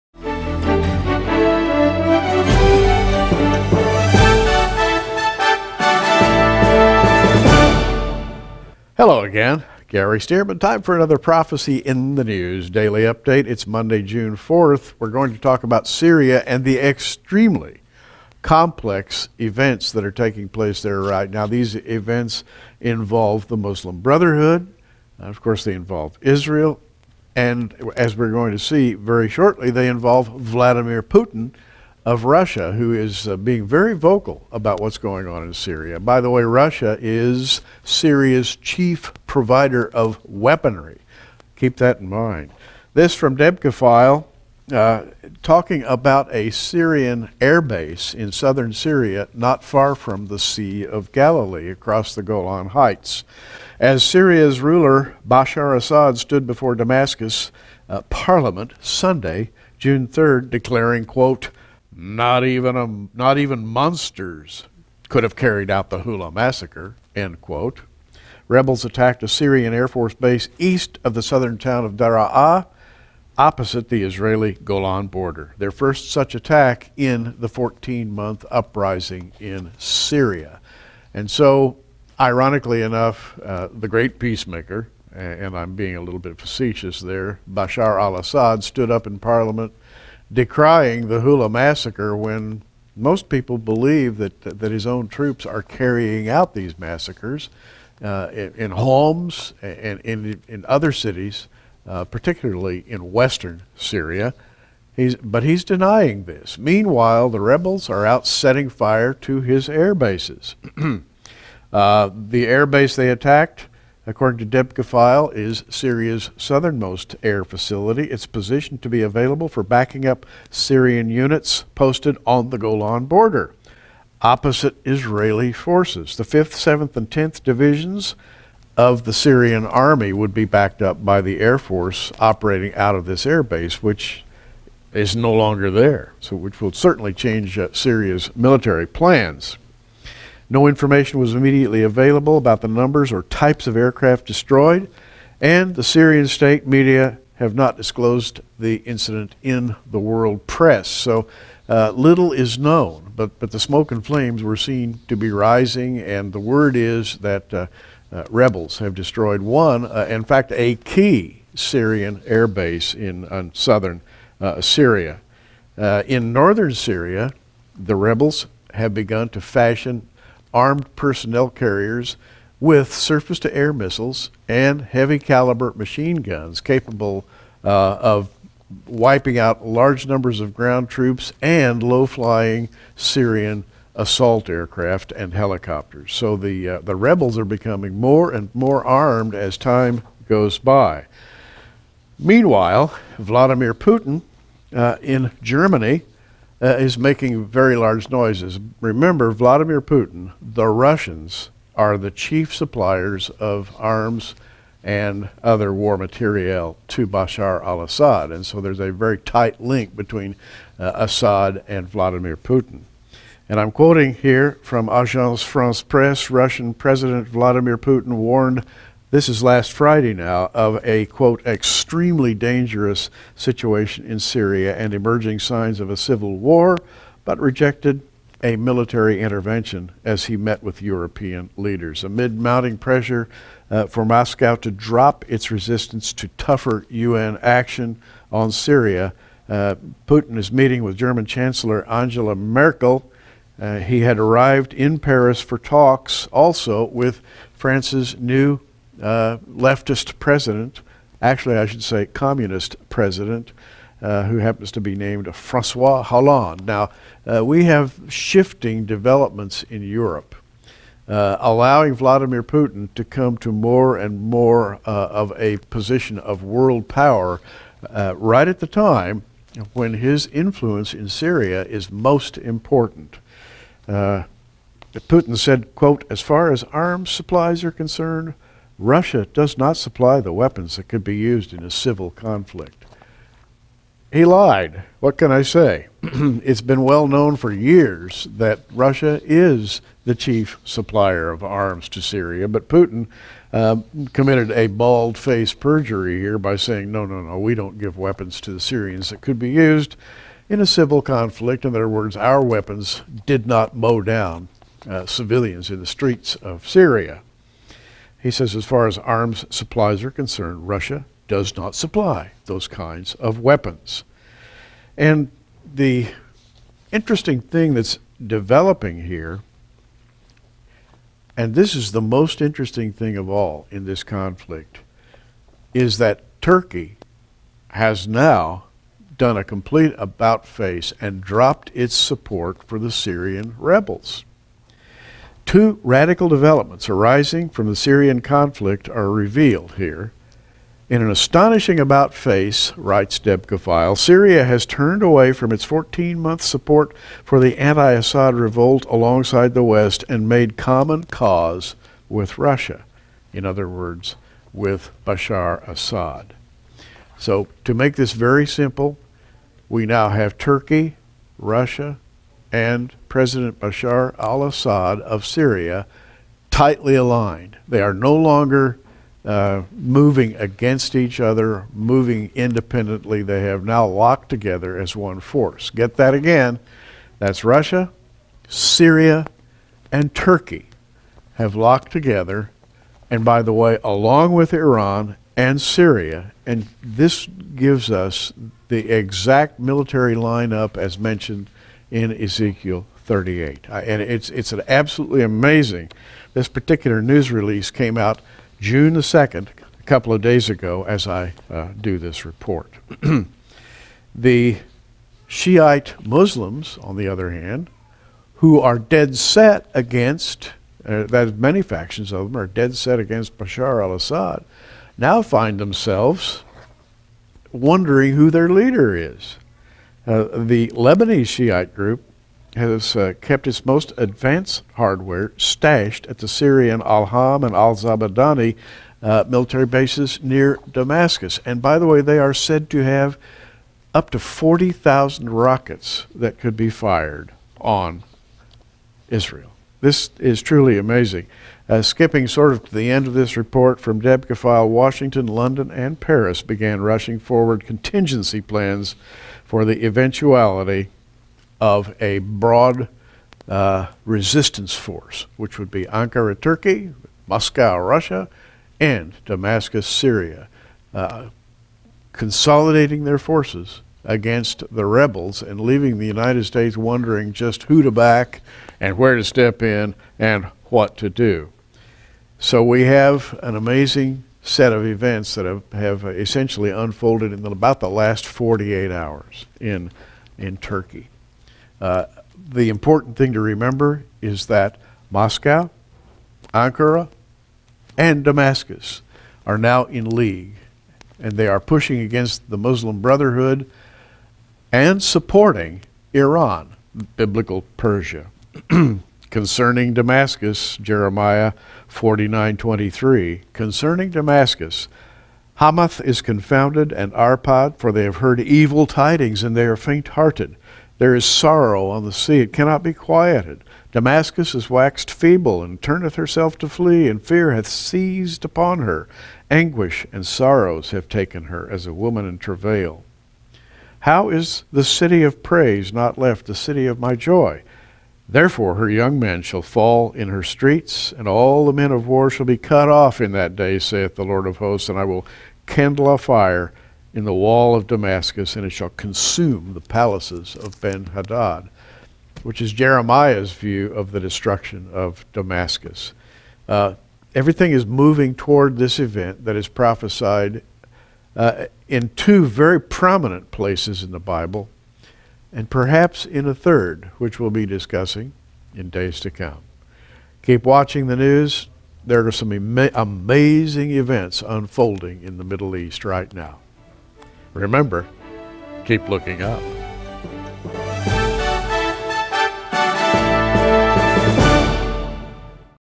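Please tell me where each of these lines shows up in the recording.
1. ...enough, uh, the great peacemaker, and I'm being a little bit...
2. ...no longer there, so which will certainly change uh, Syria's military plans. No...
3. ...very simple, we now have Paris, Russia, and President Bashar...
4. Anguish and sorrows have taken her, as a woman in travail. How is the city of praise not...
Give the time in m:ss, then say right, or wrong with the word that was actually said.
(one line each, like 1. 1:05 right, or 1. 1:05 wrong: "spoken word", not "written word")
1. 1:22 right
2. 2:15 right
3. 5:58 wrong: "Turkey", not "Paris"
4. 8:39 right.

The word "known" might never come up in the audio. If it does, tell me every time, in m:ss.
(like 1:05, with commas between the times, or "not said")
2:32, 4:47.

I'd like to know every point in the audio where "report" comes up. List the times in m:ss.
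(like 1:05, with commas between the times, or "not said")
6:42, 7:23.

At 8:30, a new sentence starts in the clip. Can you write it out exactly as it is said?
There is sorrow on the sea, it cannot be quieted.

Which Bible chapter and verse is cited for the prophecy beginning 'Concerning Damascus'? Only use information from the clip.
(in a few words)
Jeremiah 49:23.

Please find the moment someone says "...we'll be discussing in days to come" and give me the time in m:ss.
9:17.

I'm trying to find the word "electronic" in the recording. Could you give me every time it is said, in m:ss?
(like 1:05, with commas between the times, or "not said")
not said.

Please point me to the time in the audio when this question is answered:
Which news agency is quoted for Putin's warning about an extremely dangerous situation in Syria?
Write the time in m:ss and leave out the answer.
3:34.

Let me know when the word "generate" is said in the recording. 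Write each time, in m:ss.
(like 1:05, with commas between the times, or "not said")
not said.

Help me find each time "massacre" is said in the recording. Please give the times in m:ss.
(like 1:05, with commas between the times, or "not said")
1:06, 1:31, 1:36.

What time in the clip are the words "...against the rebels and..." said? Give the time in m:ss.
7:44.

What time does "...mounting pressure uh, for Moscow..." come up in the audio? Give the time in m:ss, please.
3:52.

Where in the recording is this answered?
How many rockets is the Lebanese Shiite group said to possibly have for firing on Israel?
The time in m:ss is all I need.
7:14.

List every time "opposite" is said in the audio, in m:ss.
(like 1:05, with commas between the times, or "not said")
1:13, 2:04.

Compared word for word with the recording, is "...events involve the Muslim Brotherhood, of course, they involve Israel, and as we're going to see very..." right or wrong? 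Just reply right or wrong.
right.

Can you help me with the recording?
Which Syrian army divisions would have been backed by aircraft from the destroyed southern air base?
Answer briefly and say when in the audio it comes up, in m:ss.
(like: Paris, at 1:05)
5th, 7th, and 10th, at 2:06.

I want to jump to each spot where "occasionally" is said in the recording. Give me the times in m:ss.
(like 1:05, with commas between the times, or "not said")
not said.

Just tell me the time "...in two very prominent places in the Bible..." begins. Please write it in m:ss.
9:11.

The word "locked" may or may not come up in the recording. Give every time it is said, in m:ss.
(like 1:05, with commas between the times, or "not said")
6:13, 6:21.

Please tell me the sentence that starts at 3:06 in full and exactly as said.
So the, uh, the rebels are becoming more and more armed as time goes by.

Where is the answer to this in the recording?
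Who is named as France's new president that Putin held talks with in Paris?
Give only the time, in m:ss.
4:15.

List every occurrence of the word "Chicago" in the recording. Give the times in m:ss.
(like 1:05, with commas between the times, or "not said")
not said.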